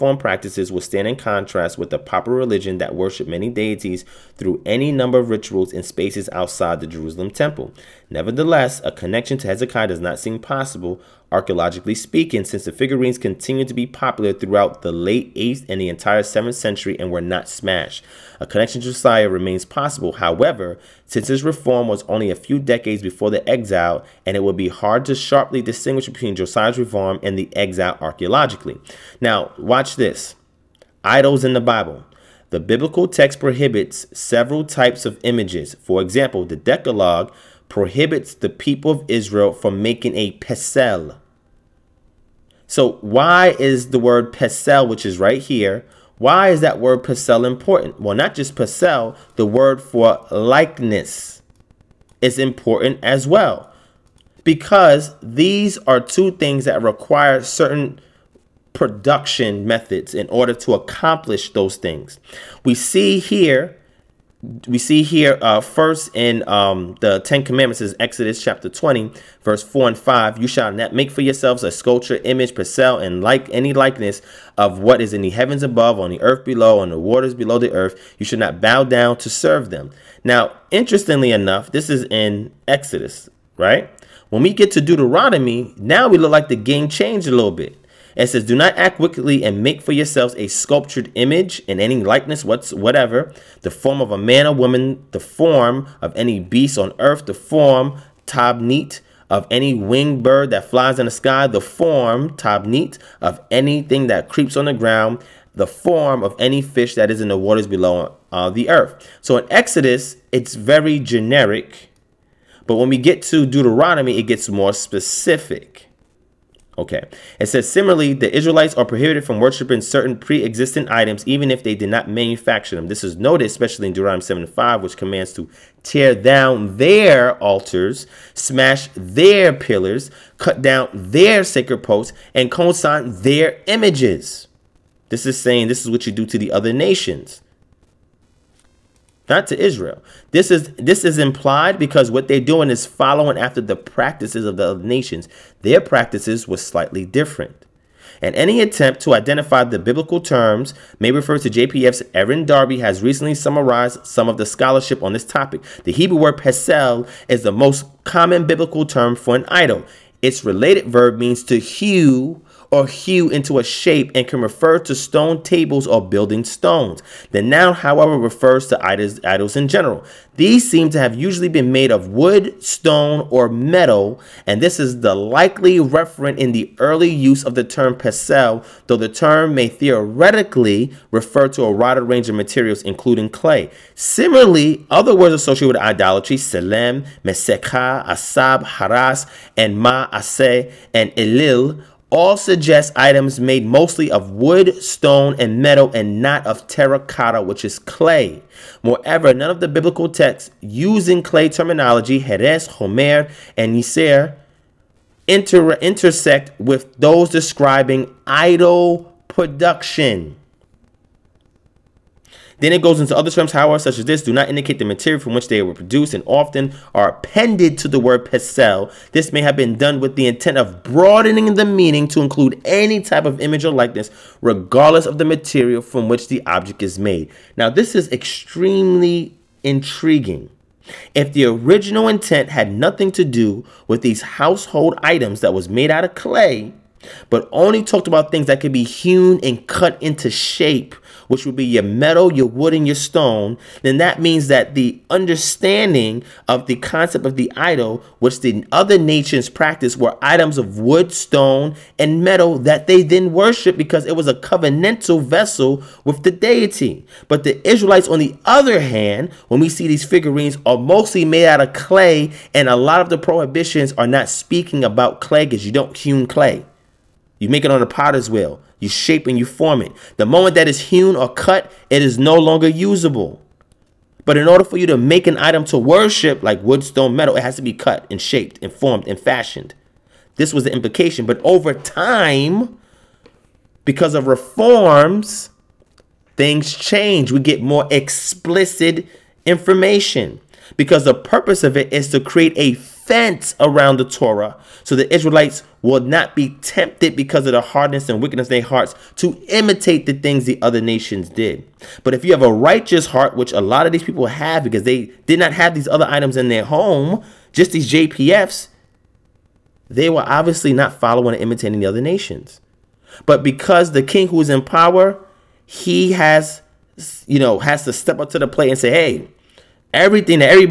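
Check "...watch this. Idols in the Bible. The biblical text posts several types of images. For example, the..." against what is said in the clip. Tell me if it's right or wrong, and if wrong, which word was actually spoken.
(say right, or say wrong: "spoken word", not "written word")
wrong: "prohibits", not "posts".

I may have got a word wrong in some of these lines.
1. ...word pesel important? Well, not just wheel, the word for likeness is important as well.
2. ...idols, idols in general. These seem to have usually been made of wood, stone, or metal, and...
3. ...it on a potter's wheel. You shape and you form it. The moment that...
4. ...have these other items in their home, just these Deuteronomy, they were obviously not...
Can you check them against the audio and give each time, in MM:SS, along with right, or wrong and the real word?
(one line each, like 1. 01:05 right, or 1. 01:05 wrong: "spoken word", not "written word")
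1. 00:46 wrong: "pesel", not "wheel"
2. 02:48 right
3. 04:27 right
4. 05:05 wrong: "JPFs", not "Deuteronomy".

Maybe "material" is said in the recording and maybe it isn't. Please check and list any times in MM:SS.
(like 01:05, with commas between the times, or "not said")
03:02, 03:34, 03:45.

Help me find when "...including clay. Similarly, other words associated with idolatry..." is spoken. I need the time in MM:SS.
03:02.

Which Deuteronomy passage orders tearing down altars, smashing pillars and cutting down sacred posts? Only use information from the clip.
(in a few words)
Deuteronomy 7:5.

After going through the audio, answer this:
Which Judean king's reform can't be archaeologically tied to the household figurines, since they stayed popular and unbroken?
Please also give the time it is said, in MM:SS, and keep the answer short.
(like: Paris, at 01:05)
Hezekiah, at 00:09.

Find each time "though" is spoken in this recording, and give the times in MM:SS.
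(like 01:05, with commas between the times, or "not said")
02:58.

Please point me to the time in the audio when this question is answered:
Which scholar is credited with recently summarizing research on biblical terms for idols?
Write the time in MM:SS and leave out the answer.
02:32.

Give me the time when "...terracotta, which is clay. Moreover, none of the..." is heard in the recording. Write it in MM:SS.
03:16.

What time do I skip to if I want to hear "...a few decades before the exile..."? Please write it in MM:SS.
00:22.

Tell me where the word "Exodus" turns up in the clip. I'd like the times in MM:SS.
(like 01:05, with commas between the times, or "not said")
01:07, 01:22, 01:49.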